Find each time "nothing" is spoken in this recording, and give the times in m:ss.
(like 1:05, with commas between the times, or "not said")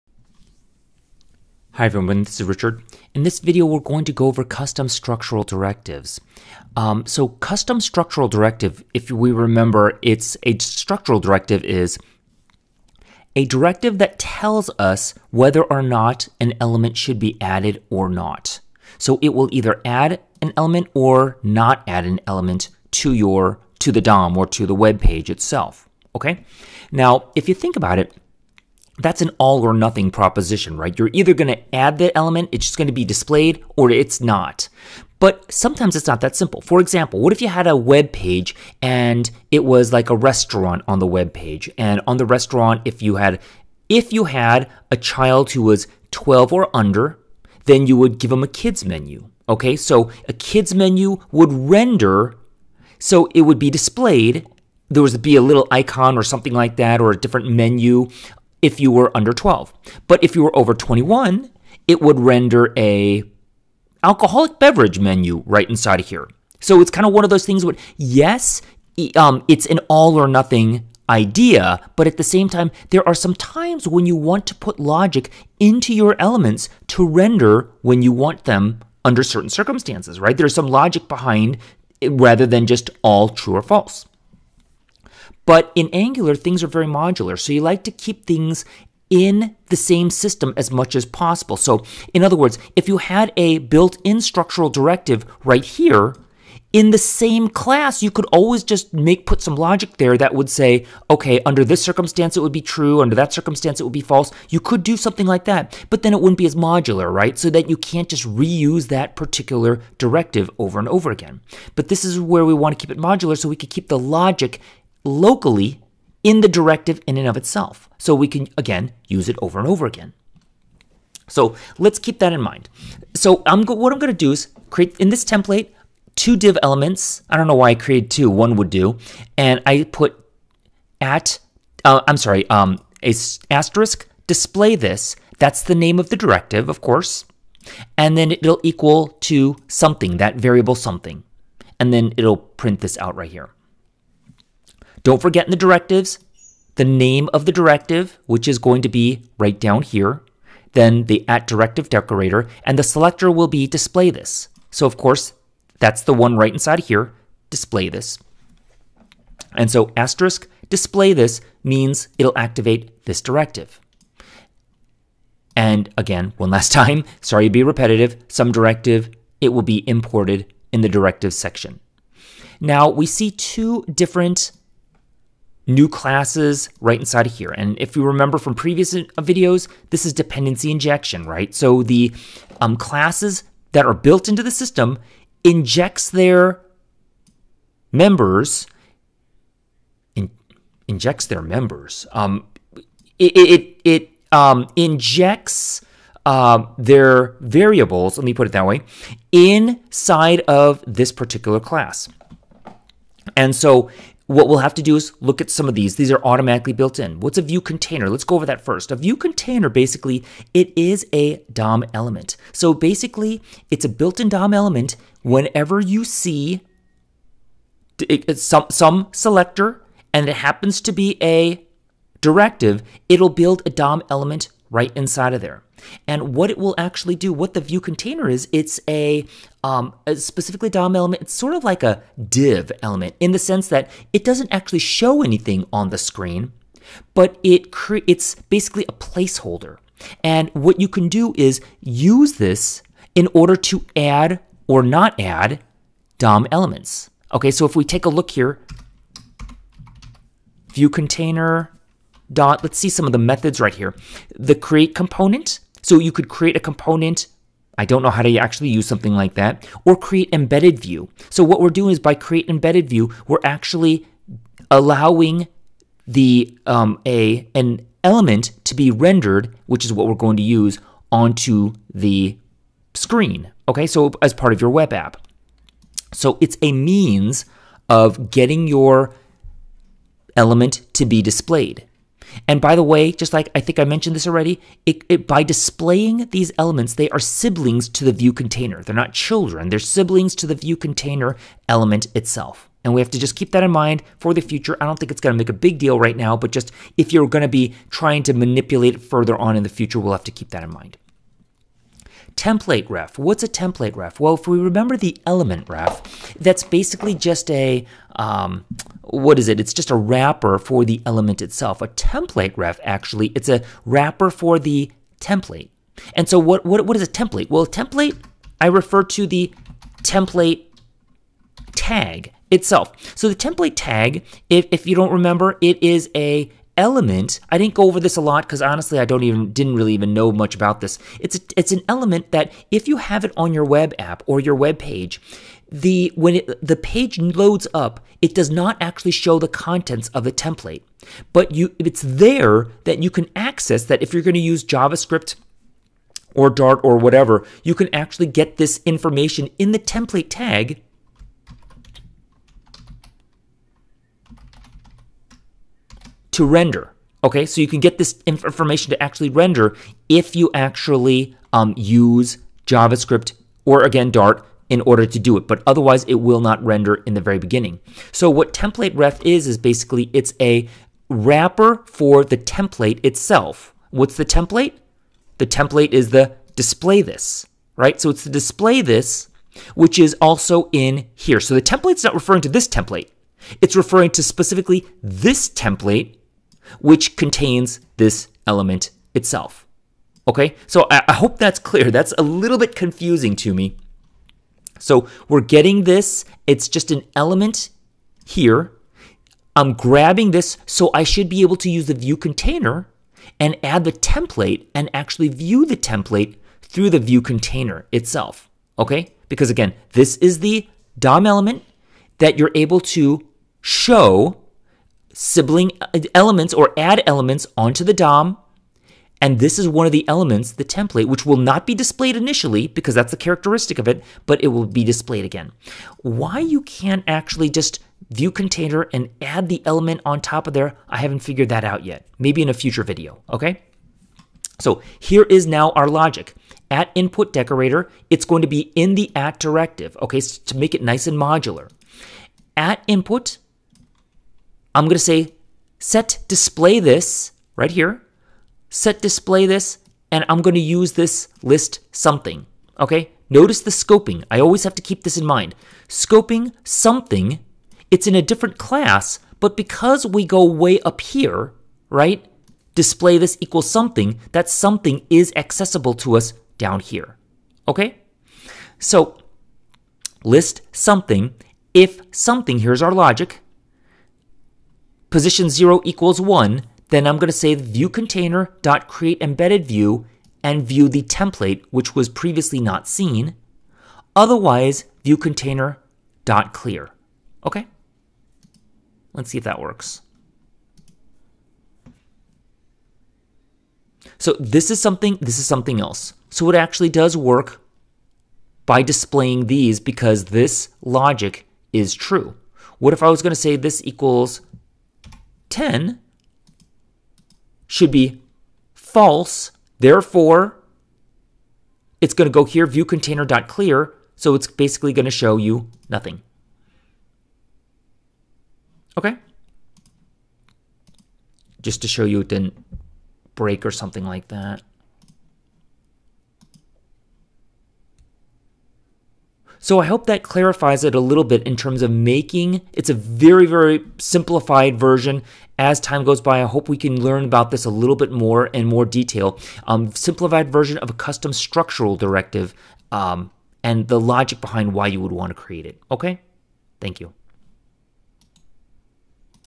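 0:29, 1:10, 8:35.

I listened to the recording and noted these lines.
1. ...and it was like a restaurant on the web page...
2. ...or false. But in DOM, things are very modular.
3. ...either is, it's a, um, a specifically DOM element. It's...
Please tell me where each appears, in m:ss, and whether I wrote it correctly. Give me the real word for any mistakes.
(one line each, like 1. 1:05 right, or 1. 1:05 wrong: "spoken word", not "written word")
1. 0:38 right
2. 1:23 wrong: "Angular", not "DOM"
3. 3:47 wrong: "container", not "either".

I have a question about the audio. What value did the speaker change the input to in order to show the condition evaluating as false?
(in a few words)
10.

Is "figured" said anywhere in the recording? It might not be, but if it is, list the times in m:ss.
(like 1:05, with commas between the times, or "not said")
7:11.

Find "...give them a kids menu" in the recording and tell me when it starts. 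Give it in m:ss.
0:48.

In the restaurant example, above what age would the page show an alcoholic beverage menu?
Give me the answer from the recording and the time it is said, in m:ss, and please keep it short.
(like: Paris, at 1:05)
21, at 1:00.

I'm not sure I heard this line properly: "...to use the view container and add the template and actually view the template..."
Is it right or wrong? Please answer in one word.
right.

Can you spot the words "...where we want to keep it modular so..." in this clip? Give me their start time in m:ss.
1:52.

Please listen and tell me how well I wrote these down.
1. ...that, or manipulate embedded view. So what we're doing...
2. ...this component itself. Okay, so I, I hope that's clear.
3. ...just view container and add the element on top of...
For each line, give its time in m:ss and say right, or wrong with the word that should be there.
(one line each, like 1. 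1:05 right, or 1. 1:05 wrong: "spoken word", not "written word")
1. 4:19 wrong: "create", not "manipulate"
2. 6:27 wrong: "element", not "component"
3. 7:07 right.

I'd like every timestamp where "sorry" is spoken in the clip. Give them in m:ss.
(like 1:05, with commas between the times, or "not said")
2:12, 2:47.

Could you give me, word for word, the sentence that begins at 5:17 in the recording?
Well, a template, I refer to the template tag itself.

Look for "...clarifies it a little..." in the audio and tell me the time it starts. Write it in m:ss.
8:50.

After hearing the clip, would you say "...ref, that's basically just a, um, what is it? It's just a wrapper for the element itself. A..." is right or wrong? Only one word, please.
right.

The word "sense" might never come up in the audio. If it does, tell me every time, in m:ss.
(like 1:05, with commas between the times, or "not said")
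3:53.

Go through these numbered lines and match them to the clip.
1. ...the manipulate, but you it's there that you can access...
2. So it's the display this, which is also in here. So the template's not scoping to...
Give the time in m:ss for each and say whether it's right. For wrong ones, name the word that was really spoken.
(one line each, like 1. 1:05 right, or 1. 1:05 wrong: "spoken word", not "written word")
1. 5:40 wrong: "template", not "manipulate"
2. 6:18 wrong: "referring", not "scoping".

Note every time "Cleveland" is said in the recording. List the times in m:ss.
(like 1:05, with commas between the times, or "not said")
not said.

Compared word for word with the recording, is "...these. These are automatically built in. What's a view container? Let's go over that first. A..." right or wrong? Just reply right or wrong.
right.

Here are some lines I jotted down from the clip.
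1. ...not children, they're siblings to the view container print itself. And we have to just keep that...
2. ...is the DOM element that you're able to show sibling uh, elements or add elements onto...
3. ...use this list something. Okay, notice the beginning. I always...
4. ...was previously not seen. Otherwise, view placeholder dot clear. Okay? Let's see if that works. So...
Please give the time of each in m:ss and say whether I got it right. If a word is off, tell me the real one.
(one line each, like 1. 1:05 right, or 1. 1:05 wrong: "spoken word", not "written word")
1. 4:48 wrong: "element", not "print"
2. 6:50 right
3. 7:30 wrong: "scoping", not "beginning"
4. 8:01 wrong: "container", not "placeholder".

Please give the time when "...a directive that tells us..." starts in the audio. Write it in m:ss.
0:13.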